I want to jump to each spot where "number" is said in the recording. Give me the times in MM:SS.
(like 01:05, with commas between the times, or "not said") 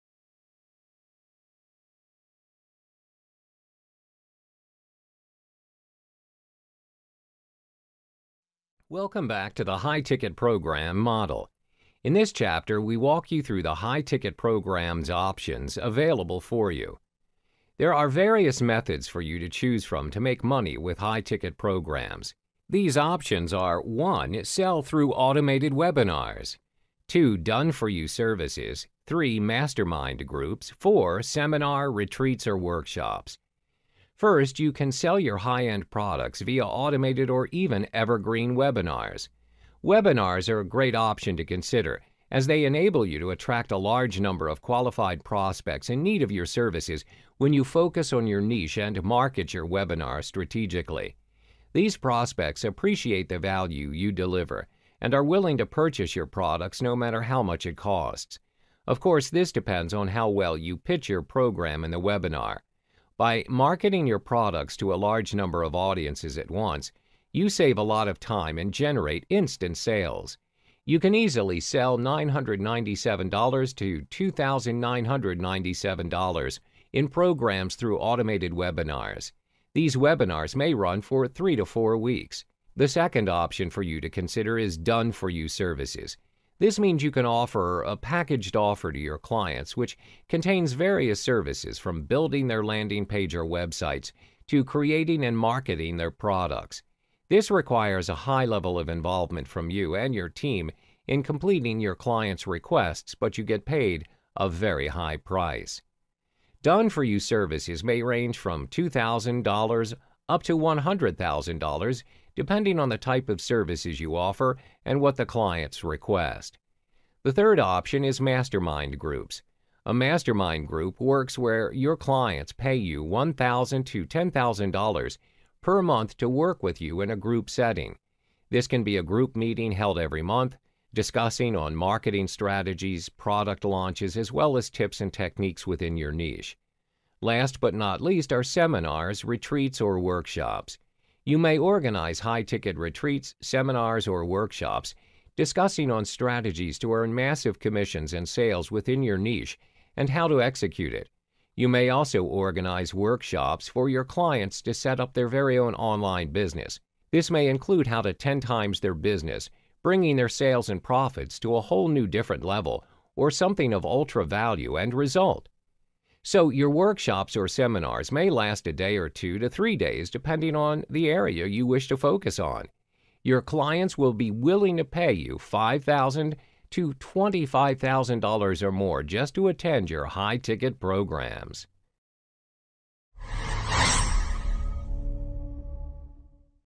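00:44, 01:05.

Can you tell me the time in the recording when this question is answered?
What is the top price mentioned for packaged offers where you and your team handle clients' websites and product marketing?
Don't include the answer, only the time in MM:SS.
01:50.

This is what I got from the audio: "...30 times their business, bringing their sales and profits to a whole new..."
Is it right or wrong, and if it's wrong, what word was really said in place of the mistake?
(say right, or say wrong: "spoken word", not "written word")
wrong: "10", not "30".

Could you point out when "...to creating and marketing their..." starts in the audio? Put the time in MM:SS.
01:34.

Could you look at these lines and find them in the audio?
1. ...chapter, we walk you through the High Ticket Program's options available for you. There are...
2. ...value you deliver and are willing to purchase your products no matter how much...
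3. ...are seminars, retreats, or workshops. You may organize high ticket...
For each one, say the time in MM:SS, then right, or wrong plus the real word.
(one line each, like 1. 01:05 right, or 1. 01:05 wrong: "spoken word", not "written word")
1. 00:12 right
2. 00:53 right
3. 02:18 right.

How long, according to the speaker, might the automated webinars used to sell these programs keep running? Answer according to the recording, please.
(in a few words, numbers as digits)
3 to 4 weeks.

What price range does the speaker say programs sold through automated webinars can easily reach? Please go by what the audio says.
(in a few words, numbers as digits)
$997 to $2,997.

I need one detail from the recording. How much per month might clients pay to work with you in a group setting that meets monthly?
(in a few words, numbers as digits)
$1,000 to $10,000.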